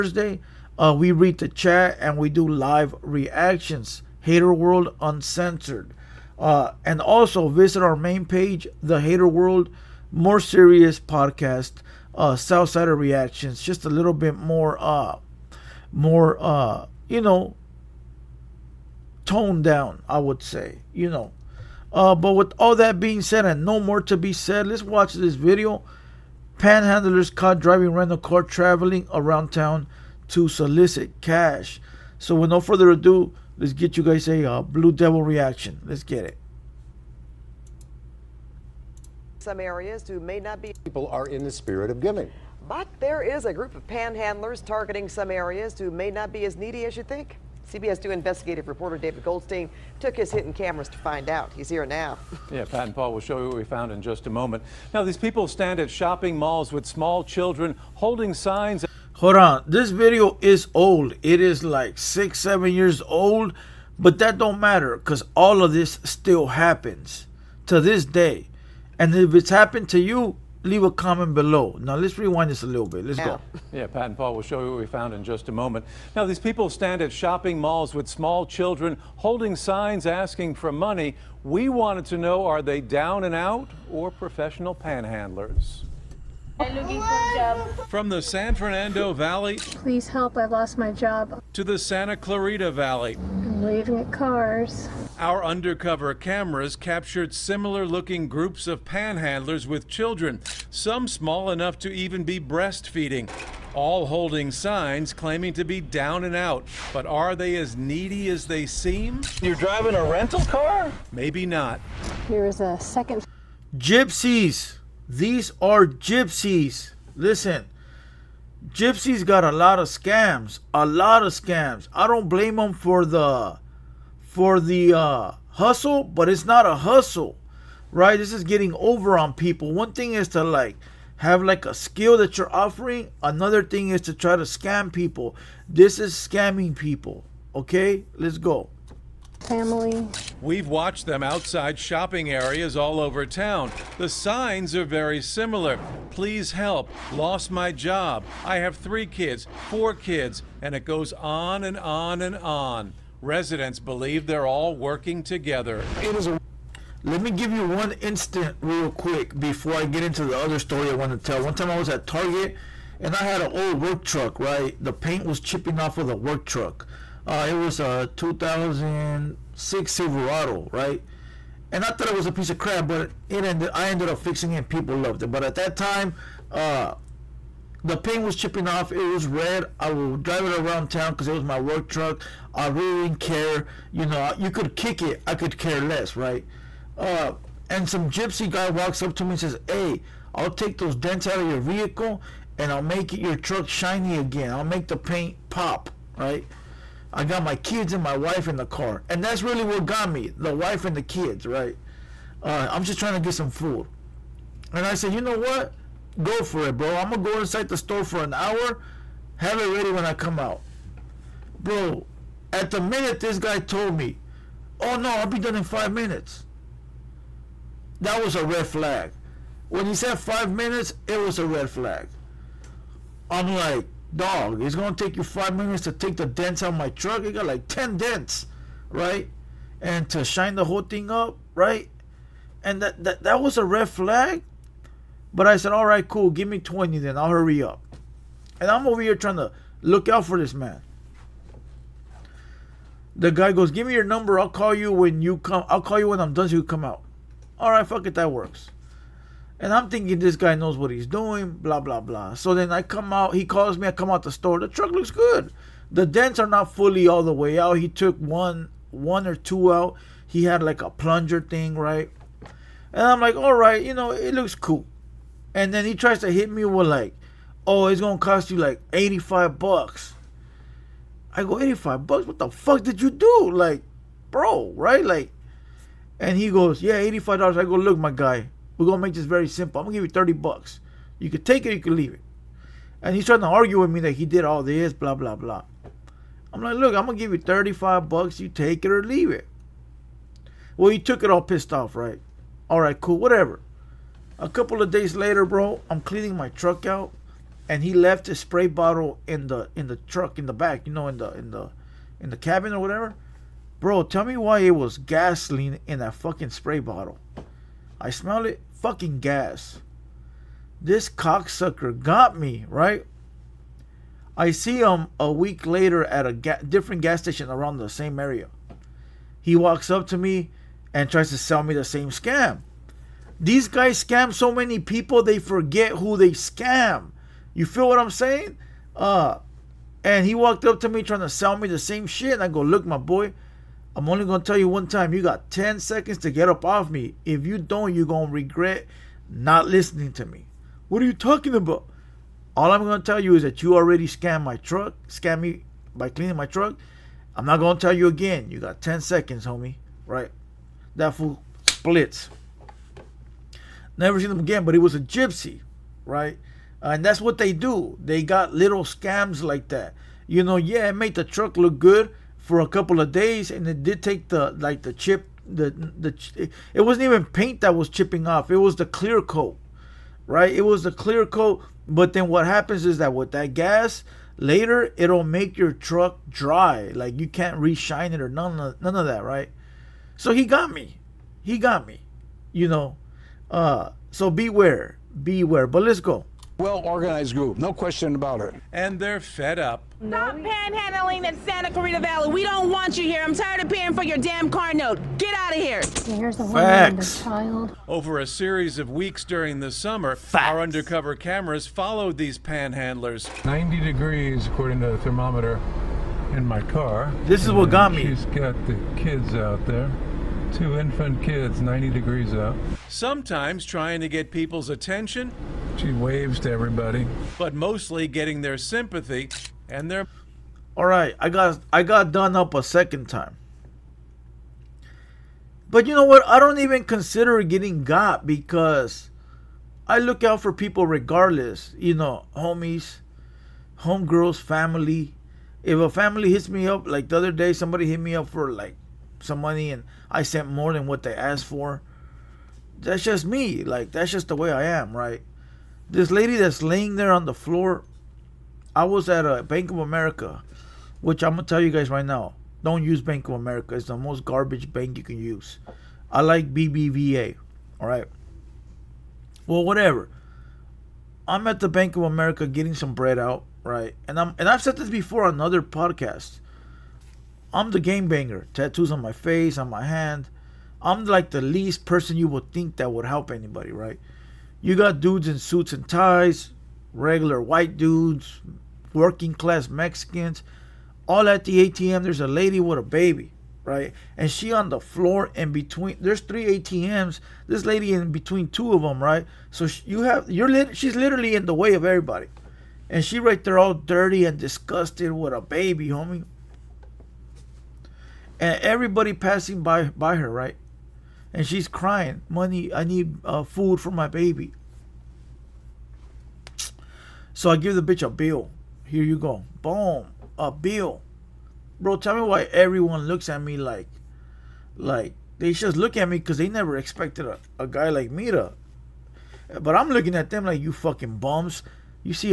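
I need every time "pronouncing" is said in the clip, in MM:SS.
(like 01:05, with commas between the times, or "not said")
not said.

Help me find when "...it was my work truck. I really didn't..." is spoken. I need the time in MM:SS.
03:01.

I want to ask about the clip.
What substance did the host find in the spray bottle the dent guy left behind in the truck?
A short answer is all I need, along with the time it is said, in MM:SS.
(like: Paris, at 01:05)
Gasoline, at 05:04.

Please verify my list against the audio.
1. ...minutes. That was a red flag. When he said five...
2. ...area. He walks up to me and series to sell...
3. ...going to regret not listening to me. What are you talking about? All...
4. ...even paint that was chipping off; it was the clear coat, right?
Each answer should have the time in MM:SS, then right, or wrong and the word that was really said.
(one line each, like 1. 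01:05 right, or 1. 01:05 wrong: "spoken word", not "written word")
1. 03:35 right
2. 05:18 wrong: "tries", not "series"
3. 05:38 right
4. 06:07 right.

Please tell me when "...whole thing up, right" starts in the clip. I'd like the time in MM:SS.
03:50.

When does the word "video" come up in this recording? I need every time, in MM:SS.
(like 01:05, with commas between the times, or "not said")
00:25, 00:59.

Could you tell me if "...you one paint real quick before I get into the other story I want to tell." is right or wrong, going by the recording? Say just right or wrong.
wrong.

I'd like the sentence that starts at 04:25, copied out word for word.
And then he tries to hit me with like, oh, it's gonna cost you like 85 bucks.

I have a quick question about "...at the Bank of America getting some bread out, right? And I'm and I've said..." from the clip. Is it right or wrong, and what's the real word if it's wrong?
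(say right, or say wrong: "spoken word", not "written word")
right.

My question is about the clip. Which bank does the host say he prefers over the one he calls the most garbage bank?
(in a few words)
BBVA.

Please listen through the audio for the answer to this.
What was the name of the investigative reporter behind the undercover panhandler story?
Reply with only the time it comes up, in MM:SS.
00:48.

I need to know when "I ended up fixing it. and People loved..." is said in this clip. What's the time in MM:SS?
02:53.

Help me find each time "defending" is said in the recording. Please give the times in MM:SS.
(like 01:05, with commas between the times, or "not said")
not said.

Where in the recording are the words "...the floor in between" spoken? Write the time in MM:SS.
08:04.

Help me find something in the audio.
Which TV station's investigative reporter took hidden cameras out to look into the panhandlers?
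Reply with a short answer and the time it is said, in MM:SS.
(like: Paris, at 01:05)
CBS 2, at 00:47.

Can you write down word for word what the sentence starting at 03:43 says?
I'm like, dog, it's gonna take you five minutes to take the dents out of my truck.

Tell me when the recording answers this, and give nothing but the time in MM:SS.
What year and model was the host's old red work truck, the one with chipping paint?
02:48.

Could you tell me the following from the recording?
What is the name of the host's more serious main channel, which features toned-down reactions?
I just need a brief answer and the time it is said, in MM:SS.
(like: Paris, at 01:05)
The Hater World, at 00:08.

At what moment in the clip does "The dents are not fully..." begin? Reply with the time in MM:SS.
04:15.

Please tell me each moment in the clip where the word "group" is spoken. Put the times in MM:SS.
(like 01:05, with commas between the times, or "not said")
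00:43, 01:38, 06:27.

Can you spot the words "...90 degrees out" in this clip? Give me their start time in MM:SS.
06:51.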